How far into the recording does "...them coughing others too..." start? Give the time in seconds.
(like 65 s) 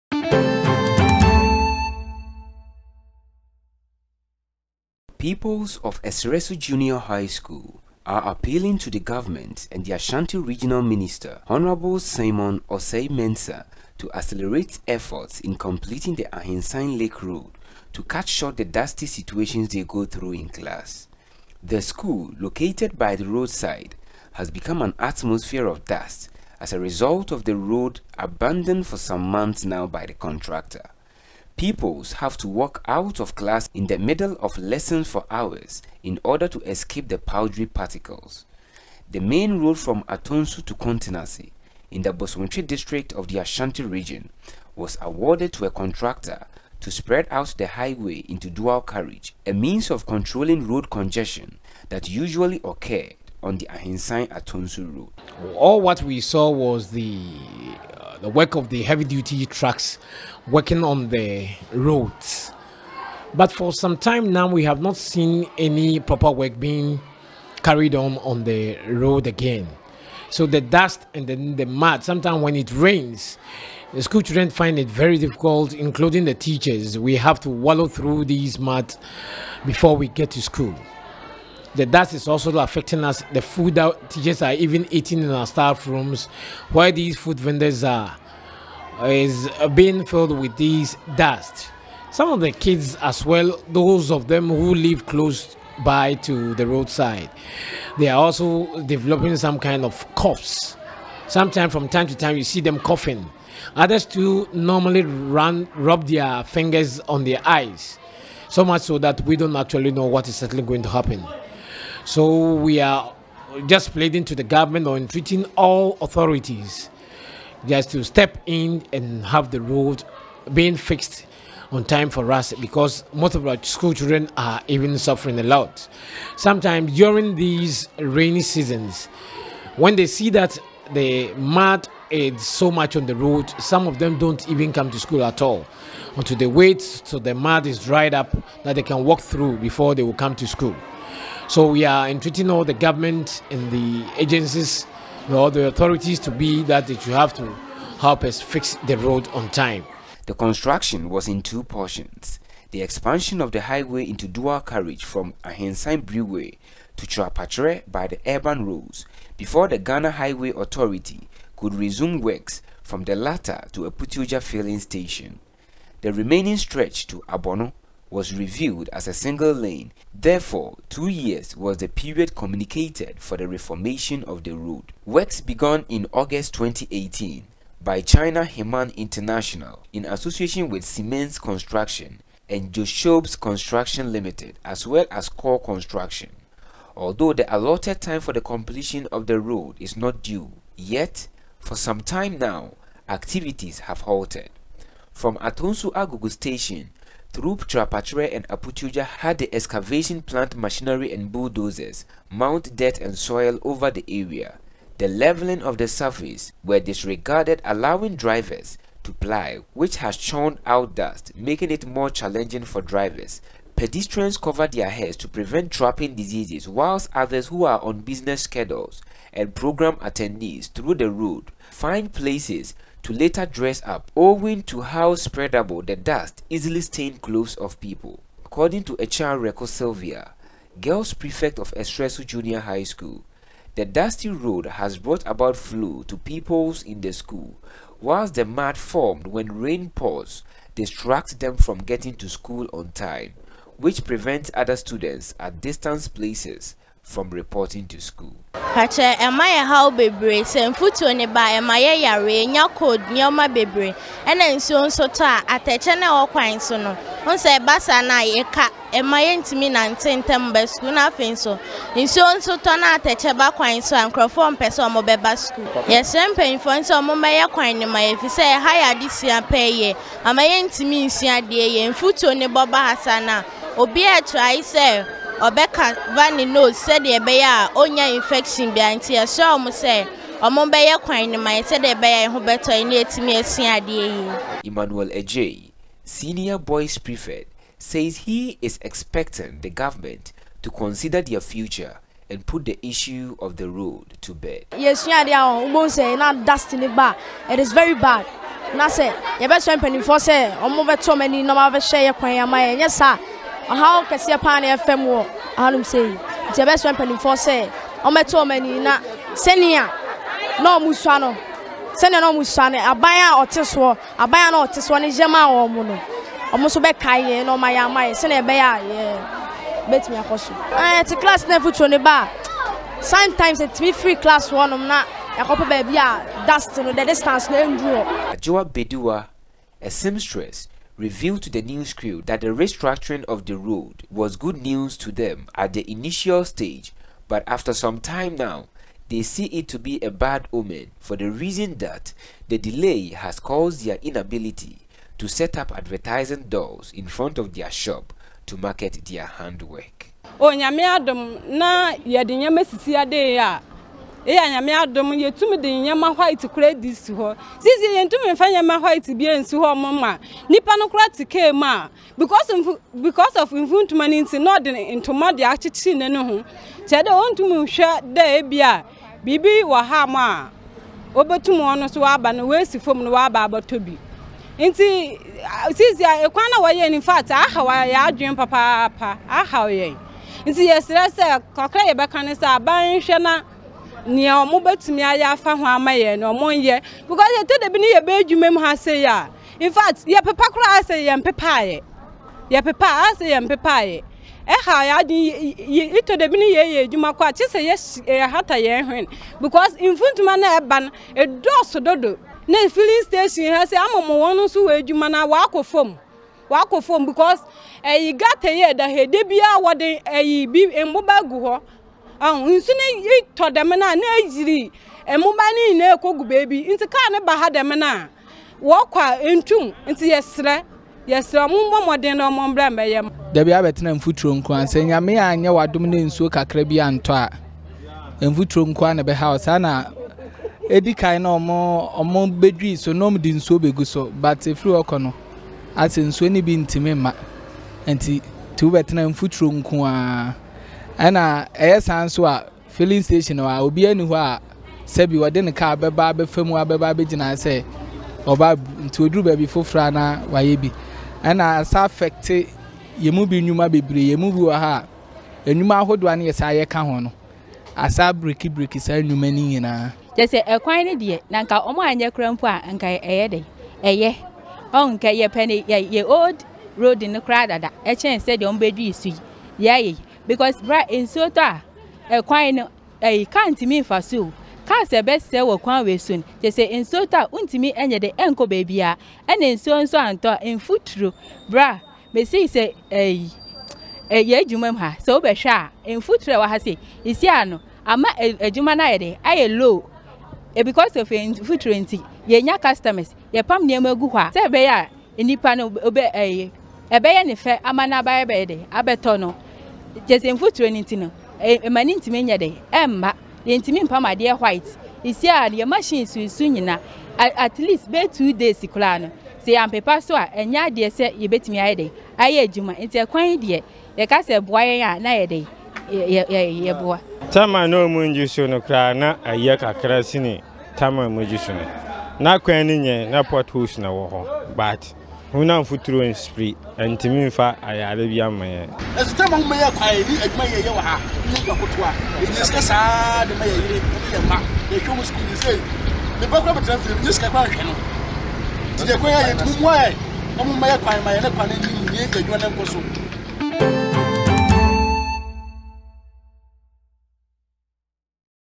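102 s.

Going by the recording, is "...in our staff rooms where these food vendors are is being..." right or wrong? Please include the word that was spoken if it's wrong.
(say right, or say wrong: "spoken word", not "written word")
right.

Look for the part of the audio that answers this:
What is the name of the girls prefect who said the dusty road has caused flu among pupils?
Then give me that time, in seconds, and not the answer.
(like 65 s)
229 s.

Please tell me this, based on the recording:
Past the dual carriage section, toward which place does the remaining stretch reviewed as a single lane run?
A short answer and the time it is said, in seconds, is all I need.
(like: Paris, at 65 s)
Abono, at 167 s.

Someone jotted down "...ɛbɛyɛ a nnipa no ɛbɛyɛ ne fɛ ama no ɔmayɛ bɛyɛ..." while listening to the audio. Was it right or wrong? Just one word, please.
wrong.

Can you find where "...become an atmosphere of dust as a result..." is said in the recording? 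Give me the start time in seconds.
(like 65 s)
24 s.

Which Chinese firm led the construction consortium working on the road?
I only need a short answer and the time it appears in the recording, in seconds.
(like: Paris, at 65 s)
China Henan International, at 178 s.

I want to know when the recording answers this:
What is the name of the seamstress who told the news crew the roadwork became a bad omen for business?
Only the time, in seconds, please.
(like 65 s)
328 s.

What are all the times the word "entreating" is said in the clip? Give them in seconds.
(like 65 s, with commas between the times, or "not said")
114 s, 142 s.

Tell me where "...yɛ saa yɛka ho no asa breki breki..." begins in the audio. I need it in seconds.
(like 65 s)
456 s.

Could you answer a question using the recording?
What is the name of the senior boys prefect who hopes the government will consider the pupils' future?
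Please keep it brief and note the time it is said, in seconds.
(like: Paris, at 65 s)
Emmanuel Ejay, at 284 s.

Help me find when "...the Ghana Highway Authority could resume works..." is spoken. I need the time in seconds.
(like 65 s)
159 s.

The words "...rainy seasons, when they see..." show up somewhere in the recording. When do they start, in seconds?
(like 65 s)
127 s.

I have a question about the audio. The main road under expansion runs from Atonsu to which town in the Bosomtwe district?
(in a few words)
Kuntenase.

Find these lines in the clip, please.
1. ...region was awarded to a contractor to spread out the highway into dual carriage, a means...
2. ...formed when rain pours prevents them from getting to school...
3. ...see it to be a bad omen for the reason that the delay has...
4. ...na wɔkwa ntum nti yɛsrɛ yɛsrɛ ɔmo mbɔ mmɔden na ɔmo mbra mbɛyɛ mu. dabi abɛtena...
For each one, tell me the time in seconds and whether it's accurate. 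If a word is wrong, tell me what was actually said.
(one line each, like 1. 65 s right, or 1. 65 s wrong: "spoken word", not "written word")
1. 43 s right
2. 238 s wrong: "distracts", not "prevents"
3. 339 s right
4. 417 s right.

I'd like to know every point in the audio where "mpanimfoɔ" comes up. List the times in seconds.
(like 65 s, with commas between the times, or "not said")
299 s, 306 s.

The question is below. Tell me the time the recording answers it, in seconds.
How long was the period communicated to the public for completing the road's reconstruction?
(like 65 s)
170 s.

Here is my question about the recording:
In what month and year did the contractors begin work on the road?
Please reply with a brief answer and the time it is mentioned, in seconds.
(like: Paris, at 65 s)
August 2018, at 176 s.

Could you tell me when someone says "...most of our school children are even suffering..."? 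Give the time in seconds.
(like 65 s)
123 s.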